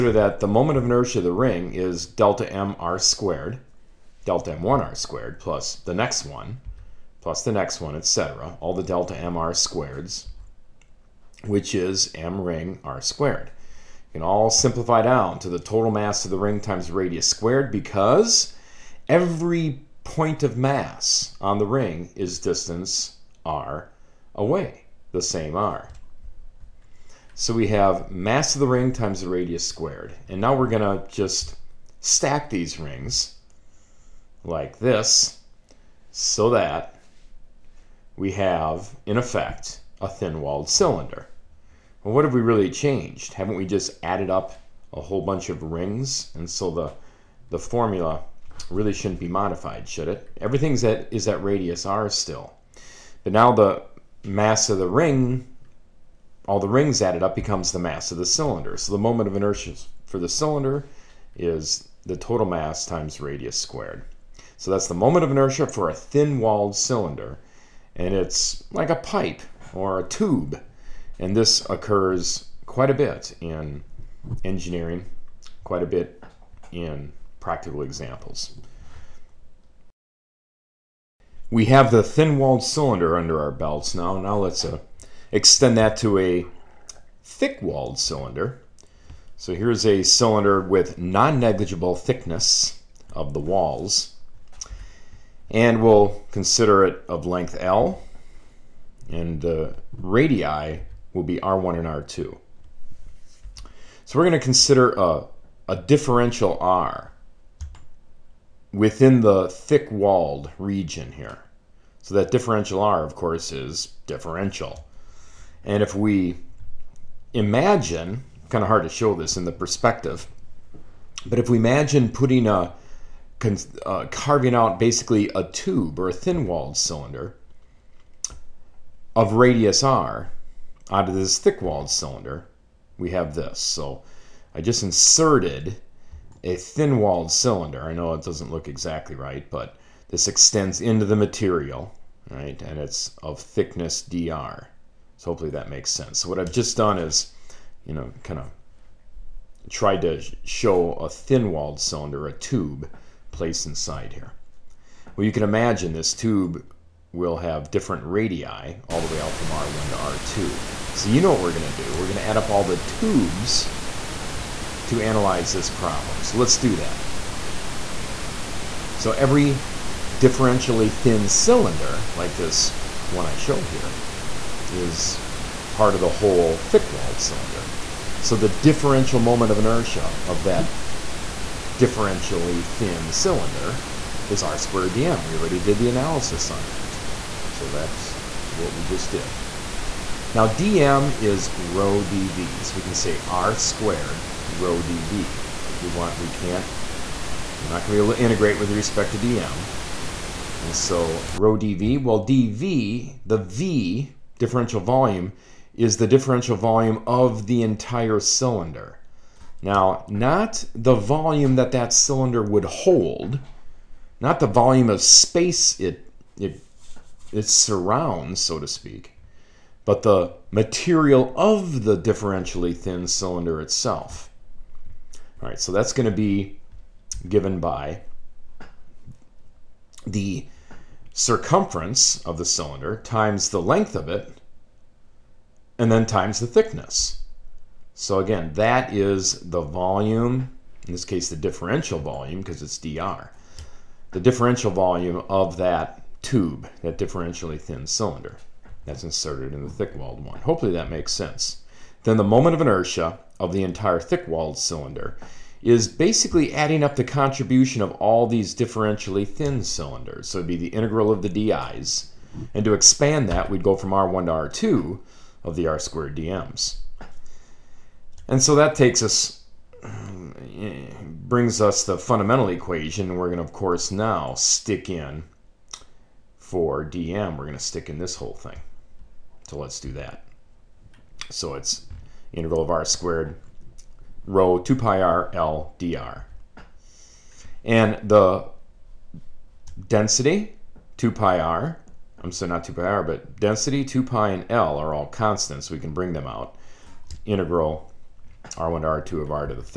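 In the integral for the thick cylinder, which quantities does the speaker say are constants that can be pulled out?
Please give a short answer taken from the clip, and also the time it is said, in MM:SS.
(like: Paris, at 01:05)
density, 2 pi, and L, at 04:53.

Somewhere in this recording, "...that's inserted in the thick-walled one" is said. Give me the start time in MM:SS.
04:08.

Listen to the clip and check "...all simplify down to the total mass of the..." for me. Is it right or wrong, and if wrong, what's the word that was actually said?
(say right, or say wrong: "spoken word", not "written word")
right.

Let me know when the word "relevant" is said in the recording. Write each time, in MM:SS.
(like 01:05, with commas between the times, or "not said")
not said.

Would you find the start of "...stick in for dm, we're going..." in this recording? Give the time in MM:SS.
04:34.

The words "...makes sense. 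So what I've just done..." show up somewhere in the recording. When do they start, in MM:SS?
02:25.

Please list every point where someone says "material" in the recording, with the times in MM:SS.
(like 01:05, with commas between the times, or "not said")
02:21, 03:40.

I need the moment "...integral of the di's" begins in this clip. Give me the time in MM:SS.
04:20.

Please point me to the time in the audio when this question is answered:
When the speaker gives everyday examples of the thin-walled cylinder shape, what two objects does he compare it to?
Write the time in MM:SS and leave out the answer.
01:08.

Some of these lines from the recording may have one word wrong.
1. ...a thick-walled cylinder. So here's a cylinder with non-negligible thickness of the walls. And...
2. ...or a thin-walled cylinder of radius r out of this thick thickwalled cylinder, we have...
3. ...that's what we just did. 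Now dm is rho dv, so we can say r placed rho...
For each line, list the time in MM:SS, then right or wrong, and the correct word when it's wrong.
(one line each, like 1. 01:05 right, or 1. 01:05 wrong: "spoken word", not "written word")
1. 01:26 right
2. 02:05 wrong: "walled", not "thickwalled"
3. 03:07 wrong: "squared", not "placed".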